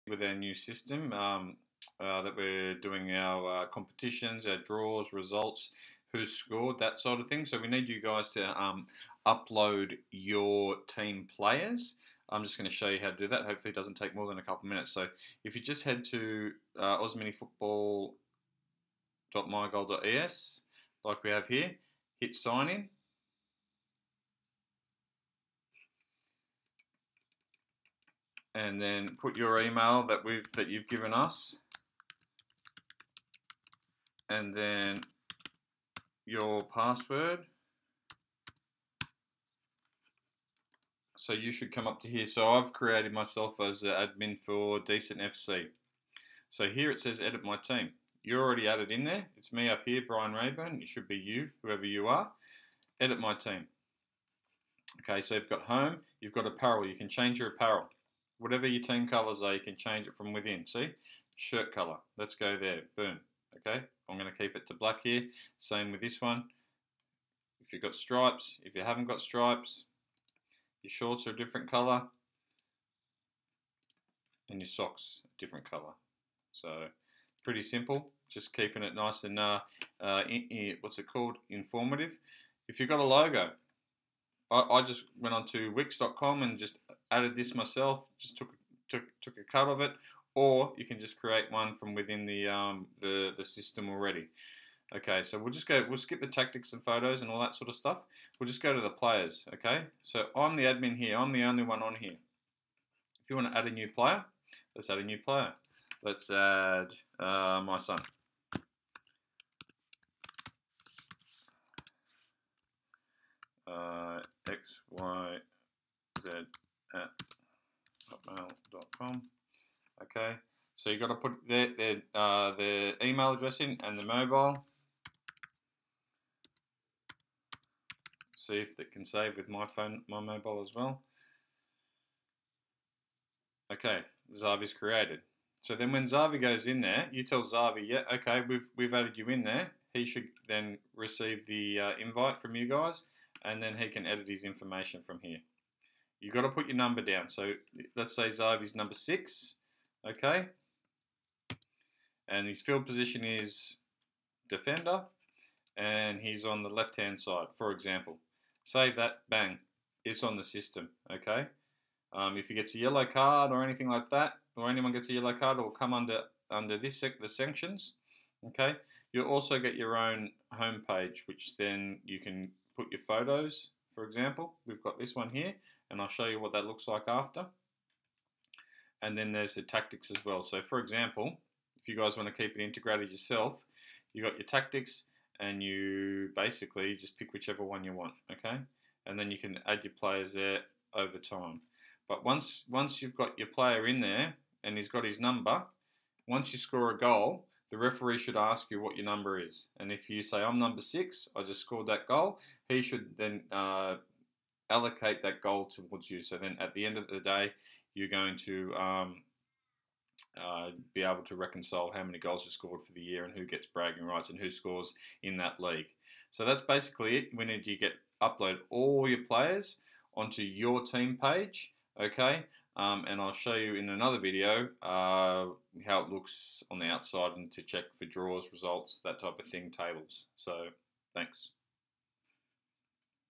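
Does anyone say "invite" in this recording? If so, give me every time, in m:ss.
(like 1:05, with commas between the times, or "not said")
2:22.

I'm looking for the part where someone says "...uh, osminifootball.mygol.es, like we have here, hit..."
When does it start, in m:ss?
0:16.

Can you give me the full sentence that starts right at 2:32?
And his field position is defender, and he's on the left-hand side, for example.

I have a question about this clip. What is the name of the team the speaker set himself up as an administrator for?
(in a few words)
Decent FC.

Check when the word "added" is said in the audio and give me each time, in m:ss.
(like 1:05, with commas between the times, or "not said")
0:48, 1:27, 2:18.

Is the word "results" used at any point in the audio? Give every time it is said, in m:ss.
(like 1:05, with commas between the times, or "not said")
0:05, 3:48.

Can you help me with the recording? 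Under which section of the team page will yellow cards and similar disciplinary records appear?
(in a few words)
Sanctions.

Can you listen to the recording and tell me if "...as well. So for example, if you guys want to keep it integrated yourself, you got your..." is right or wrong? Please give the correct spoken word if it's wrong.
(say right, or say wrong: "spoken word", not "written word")
right.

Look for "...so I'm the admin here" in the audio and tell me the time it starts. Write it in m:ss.
1:40.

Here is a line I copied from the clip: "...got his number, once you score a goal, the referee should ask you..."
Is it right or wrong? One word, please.
right.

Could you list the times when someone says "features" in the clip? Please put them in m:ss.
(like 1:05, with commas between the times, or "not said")
not said.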